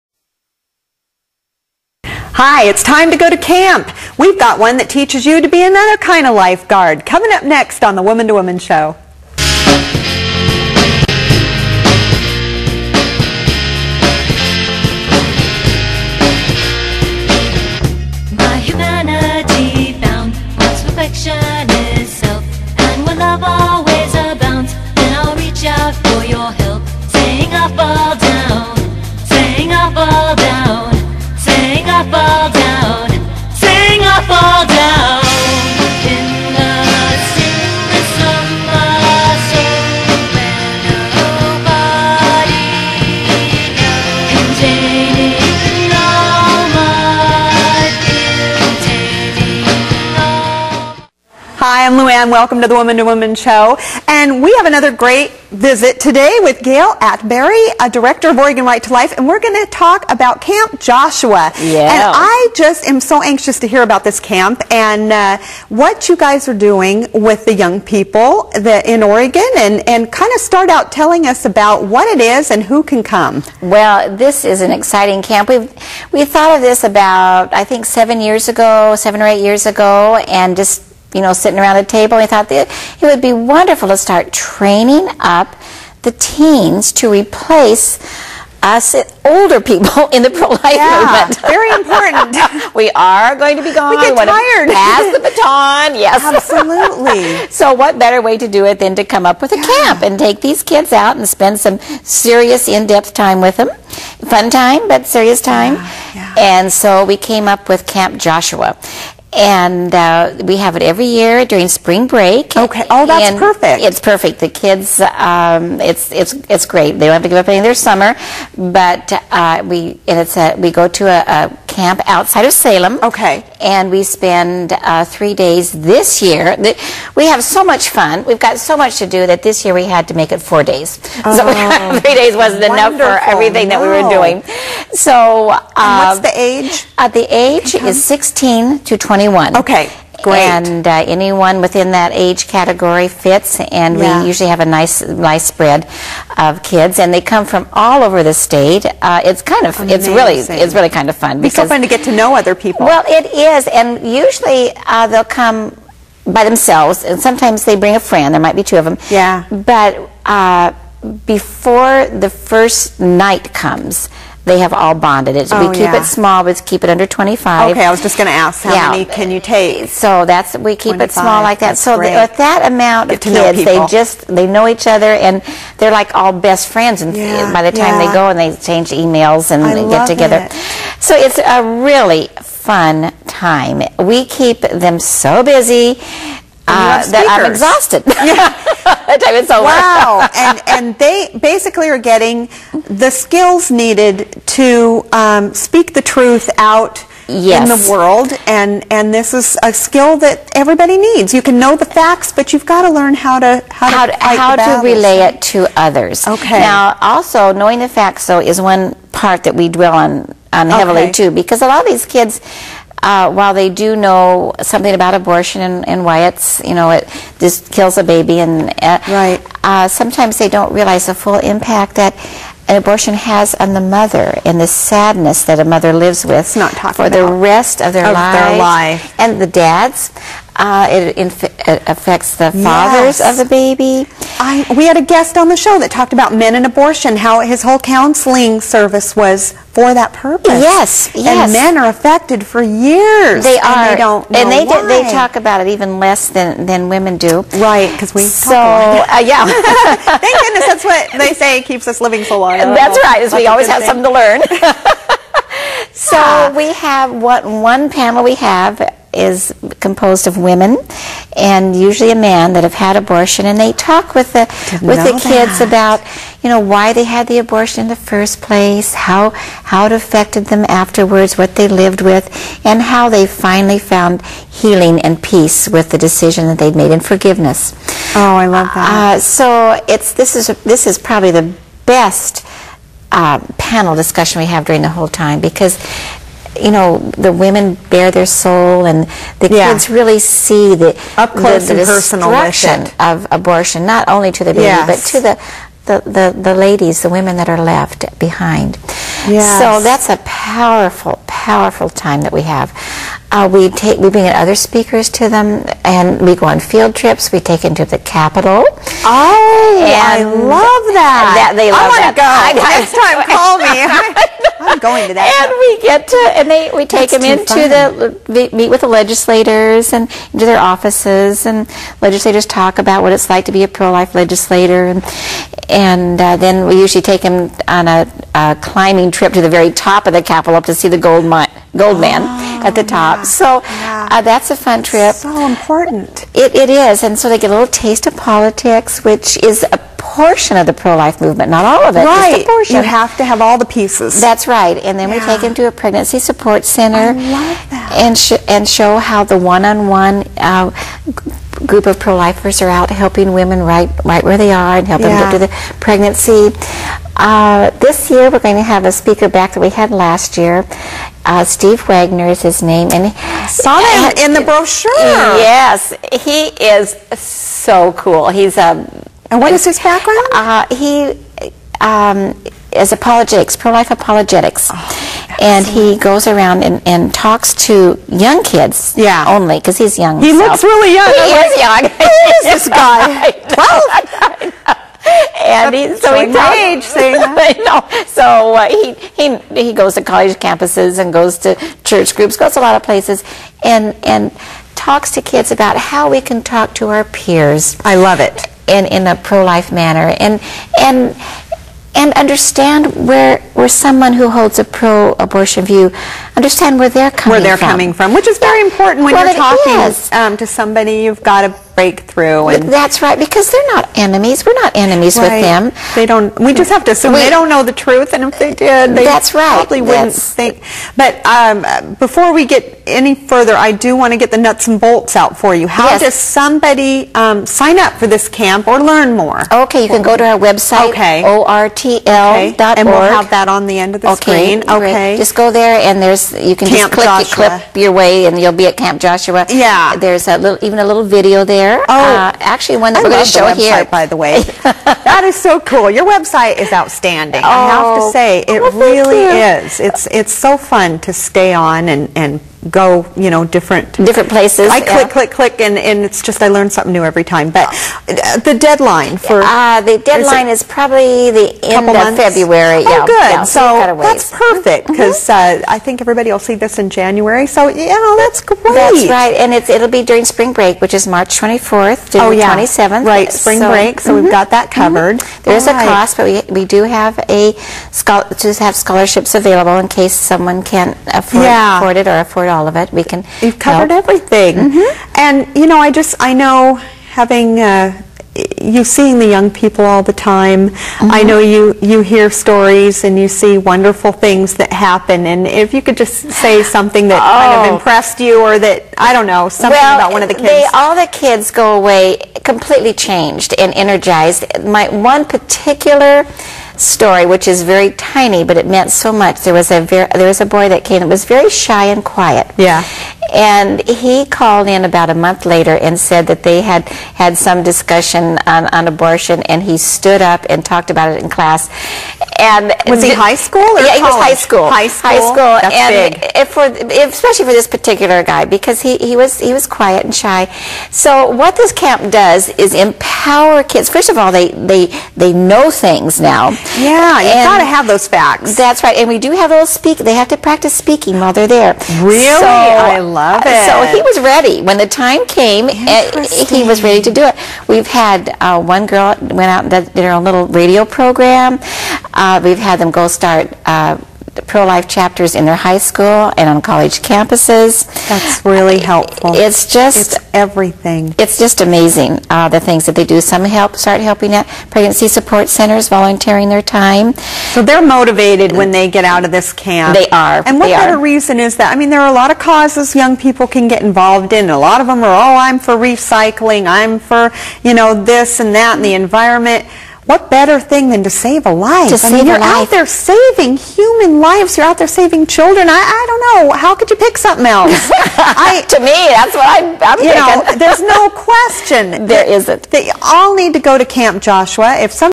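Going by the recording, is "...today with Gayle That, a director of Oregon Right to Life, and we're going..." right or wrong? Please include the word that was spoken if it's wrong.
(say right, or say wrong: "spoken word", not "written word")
wrong: "Atteberry", not "That".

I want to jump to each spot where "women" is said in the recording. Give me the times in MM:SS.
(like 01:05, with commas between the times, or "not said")
04:06, 04:20, 04:47, 04:57, 05:53.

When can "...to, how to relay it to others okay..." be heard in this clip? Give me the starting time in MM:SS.
03:24.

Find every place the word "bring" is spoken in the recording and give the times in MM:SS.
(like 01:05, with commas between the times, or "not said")
02:37, 05:04.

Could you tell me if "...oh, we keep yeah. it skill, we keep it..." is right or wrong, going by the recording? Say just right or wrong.
wrong.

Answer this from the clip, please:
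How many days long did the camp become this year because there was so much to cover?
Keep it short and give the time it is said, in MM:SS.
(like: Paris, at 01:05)
4, at 02:10.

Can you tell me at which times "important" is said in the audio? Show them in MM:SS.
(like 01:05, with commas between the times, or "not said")
01:31, 05:35, 06:48.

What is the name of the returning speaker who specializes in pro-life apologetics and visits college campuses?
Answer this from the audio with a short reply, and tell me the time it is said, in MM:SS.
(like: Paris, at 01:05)
Steve Wagner, at 06:01.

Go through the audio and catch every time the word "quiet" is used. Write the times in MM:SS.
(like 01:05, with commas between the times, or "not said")
08:32, 08:49.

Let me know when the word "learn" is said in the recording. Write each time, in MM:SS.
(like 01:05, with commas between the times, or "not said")
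03:22, 04:14, 07:08, 07:36.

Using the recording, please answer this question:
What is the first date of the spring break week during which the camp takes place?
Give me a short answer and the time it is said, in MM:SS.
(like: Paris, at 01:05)
March 24, at 07:51.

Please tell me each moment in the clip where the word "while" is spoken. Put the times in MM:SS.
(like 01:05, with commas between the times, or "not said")
03:33, 09:01.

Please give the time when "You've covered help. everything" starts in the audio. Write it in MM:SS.
08:03.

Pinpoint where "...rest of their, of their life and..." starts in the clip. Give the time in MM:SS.
03:47.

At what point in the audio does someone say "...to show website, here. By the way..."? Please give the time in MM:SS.
07:23.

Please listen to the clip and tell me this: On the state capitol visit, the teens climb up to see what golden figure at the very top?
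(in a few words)
gold man.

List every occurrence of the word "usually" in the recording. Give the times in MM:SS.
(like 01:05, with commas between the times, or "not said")
02:24, 02:34, 04:21, 05:26.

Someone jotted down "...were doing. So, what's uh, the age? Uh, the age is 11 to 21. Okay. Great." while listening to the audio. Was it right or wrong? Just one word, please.
wrong.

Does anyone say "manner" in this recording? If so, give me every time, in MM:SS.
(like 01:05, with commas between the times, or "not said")
06:39.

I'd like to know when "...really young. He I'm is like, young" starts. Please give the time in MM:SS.
06:20.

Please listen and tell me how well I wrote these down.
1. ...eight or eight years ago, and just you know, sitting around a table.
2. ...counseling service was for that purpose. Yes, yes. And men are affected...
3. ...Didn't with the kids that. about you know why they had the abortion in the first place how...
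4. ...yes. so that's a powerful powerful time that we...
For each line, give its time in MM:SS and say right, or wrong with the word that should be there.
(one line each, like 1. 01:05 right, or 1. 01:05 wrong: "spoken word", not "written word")
1. 01:18 wrong: "seven", not "eight"
2. 03:57 right
3. 04:24 right
4. 04:59 right.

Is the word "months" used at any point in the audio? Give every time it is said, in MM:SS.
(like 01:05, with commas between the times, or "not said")
07:41, 08:35.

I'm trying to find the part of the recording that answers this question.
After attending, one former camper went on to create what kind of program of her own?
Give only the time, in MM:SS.
09:10.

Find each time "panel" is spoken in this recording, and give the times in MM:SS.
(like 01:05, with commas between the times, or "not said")
04:17, 04:43.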